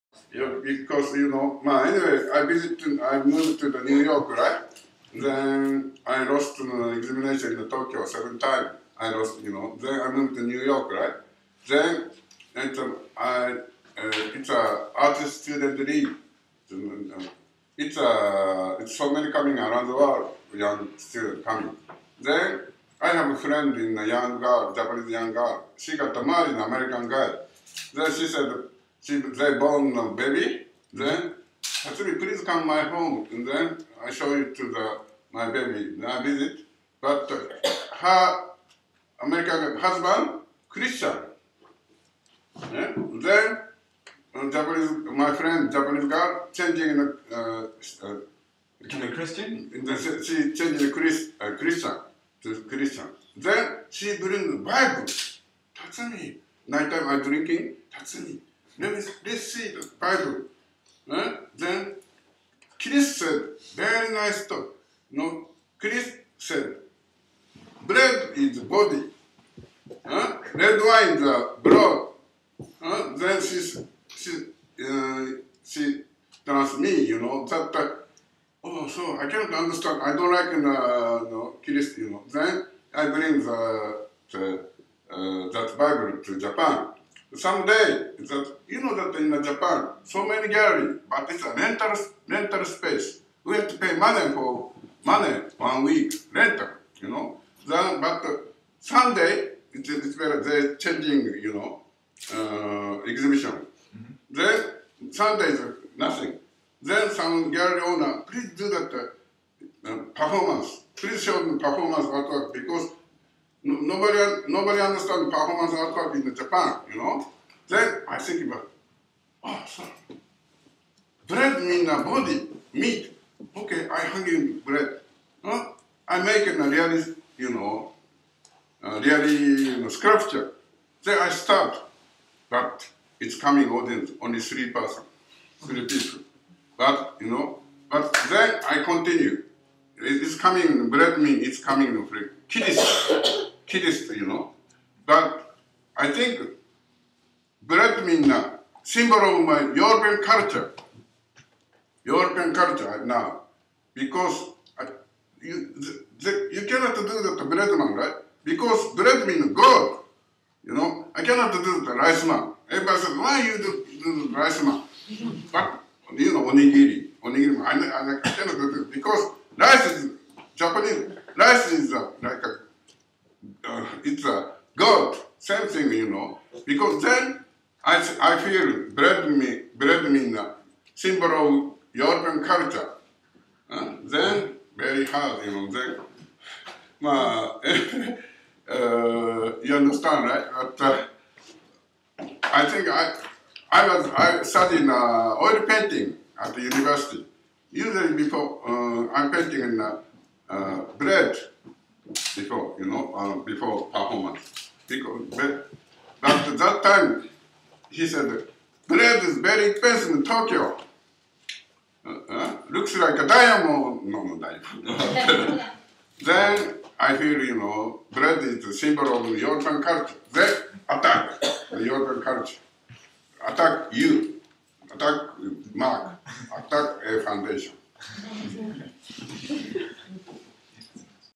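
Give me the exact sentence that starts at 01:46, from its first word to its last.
Then some gallery owner, please do that uh, performance.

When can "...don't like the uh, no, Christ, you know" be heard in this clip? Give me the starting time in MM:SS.
01:20.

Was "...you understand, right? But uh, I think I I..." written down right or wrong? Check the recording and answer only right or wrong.
right.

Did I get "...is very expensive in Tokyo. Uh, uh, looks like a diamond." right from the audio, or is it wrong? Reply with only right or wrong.
right.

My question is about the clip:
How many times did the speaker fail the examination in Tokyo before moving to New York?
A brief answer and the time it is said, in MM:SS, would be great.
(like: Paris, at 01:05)
7, at 00:08.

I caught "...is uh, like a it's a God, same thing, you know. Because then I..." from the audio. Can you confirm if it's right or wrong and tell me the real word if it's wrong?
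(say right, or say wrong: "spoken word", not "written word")
right.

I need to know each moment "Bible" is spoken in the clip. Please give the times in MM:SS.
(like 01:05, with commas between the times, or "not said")
00:54, 01:00, 01:25.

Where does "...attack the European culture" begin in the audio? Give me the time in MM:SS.
03:40.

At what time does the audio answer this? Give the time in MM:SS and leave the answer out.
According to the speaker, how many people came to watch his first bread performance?
02:15.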